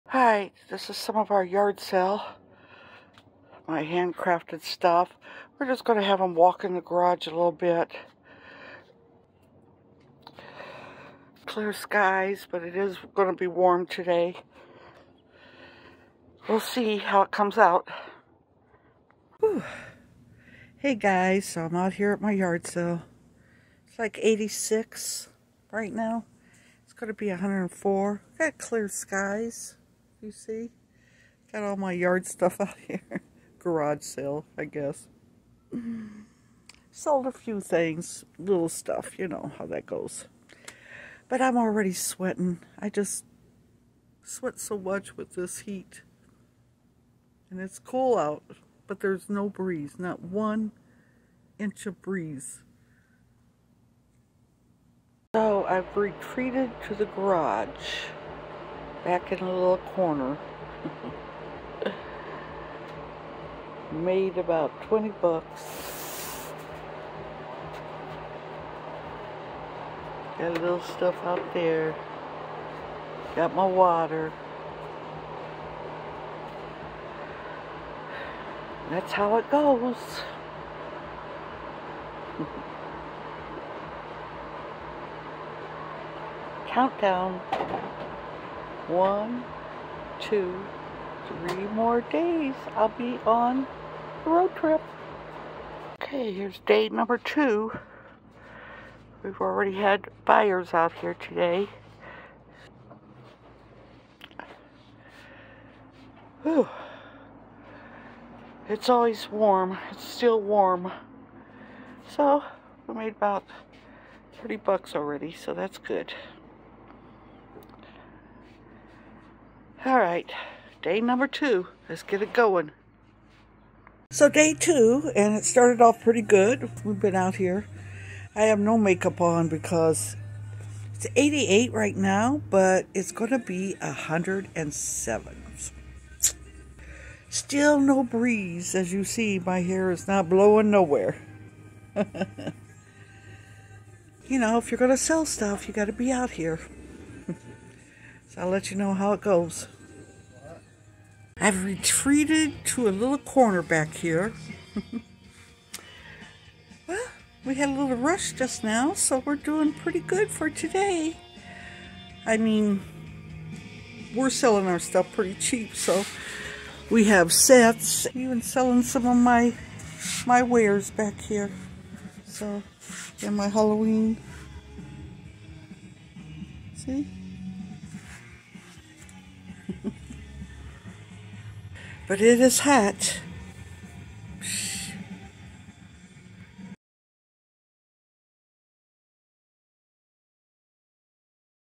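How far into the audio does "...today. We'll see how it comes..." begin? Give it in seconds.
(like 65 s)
13 s.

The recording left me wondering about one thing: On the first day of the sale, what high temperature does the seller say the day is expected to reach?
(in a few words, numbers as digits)
104.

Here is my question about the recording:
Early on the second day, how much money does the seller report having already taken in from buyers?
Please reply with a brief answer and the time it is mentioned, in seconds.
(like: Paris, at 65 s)
30 bucks, at 114 s.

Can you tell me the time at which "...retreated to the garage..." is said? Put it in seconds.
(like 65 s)
55 s.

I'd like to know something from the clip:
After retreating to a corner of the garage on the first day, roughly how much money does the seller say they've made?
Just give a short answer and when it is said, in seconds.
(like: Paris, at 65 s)
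20 bucks, at 64 s.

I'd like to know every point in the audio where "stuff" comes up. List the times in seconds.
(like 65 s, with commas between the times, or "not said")
4 s, 32 s, 38 s, 70 s, 145 s, 164 s.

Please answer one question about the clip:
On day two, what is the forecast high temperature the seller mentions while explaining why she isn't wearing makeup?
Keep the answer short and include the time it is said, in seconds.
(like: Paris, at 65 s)
107, at 133 s.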